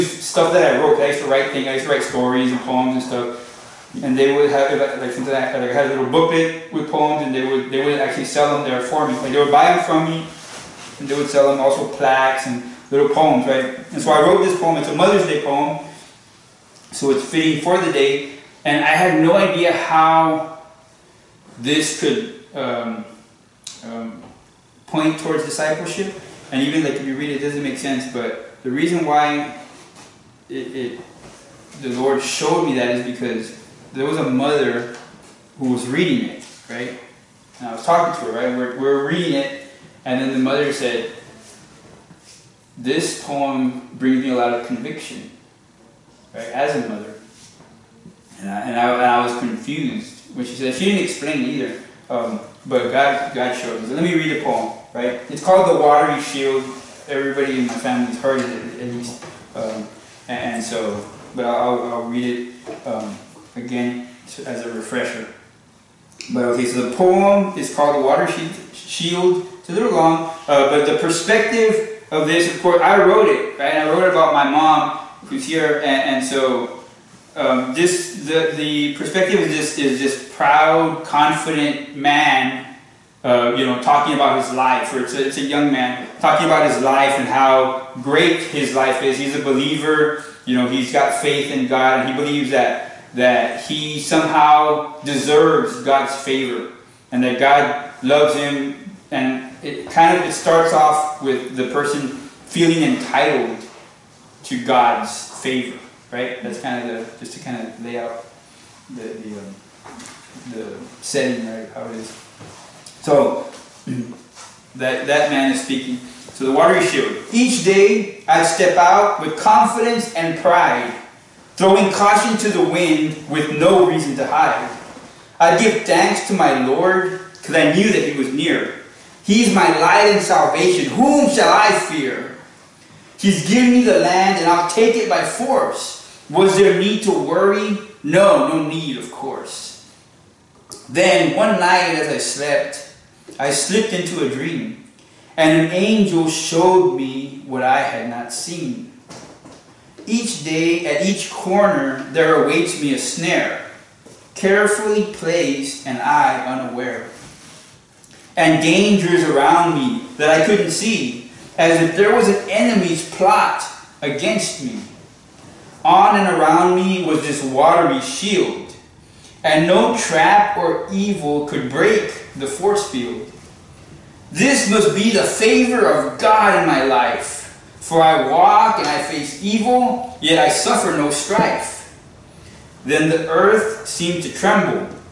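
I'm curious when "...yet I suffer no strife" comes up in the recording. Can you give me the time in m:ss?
3:00.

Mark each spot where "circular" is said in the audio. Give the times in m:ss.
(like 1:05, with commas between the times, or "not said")
not said.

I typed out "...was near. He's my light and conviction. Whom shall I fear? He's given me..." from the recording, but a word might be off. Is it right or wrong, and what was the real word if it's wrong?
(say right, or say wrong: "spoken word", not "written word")
wrong: "salvation", not "conviction".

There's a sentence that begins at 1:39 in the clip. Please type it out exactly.
And it kind of it starts off with the person feeling entitled to God's favor, right?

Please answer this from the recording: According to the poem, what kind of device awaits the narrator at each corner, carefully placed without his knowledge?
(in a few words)
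a snare.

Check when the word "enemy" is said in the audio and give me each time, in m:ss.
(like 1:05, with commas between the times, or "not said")
2:42.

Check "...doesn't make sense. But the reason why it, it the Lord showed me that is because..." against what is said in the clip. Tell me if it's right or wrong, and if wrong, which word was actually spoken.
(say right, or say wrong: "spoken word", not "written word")
right.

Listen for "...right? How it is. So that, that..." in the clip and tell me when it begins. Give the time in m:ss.
1:51.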